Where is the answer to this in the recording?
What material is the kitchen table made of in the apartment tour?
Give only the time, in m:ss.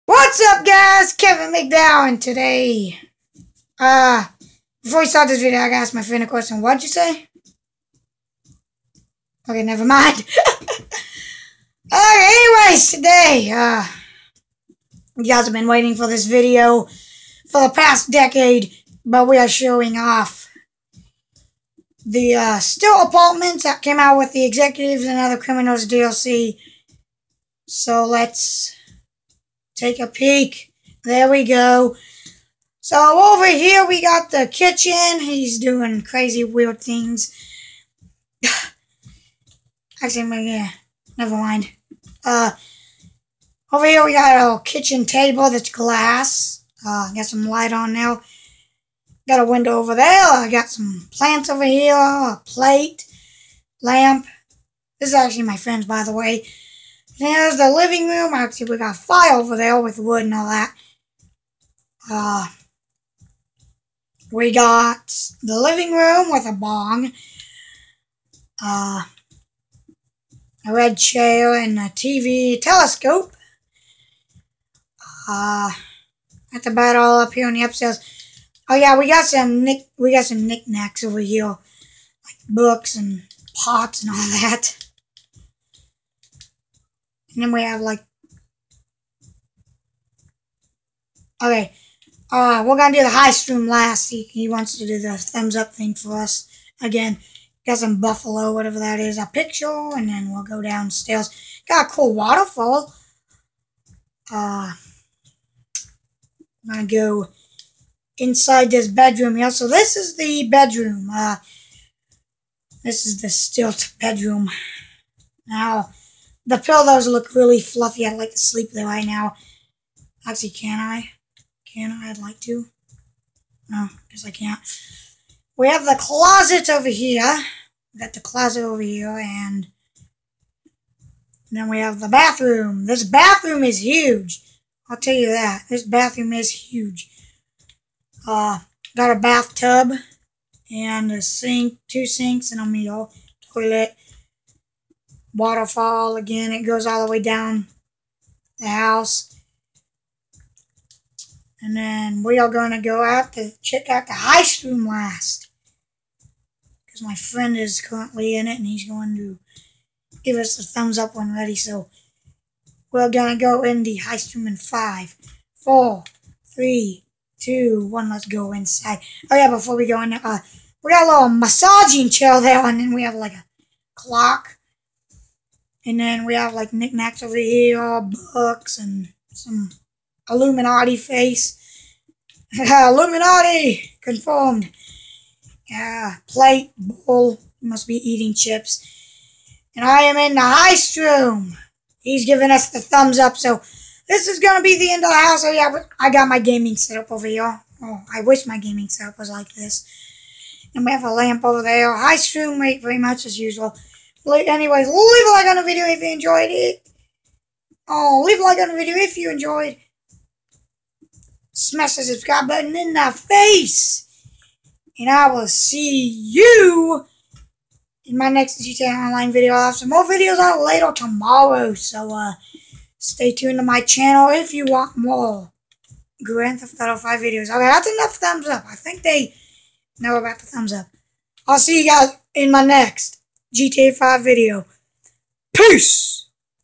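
0:45.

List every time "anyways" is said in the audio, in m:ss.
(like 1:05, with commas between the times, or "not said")
0:12, 3:24.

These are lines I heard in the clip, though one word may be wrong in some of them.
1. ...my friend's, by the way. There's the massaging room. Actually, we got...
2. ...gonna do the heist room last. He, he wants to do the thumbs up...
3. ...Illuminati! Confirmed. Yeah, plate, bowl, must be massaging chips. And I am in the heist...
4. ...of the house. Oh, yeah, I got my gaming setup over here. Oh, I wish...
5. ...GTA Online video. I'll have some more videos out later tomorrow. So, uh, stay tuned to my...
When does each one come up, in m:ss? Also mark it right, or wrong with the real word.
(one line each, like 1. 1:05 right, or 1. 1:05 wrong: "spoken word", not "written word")
1. 0:55 wrong: "living", not "massaging"
2. 1:32 right
3. 3:02 wrong: "eating", not "massaging"
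4. 3:15 right
5. 3:38 right.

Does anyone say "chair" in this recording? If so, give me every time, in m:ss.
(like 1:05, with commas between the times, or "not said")
1:10, 2:52.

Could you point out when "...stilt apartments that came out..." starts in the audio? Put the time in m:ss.
0:22.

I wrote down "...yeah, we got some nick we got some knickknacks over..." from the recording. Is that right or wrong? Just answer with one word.
right.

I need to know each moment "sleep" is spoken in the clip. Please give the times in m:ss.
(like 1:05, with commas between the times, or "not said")
1:58.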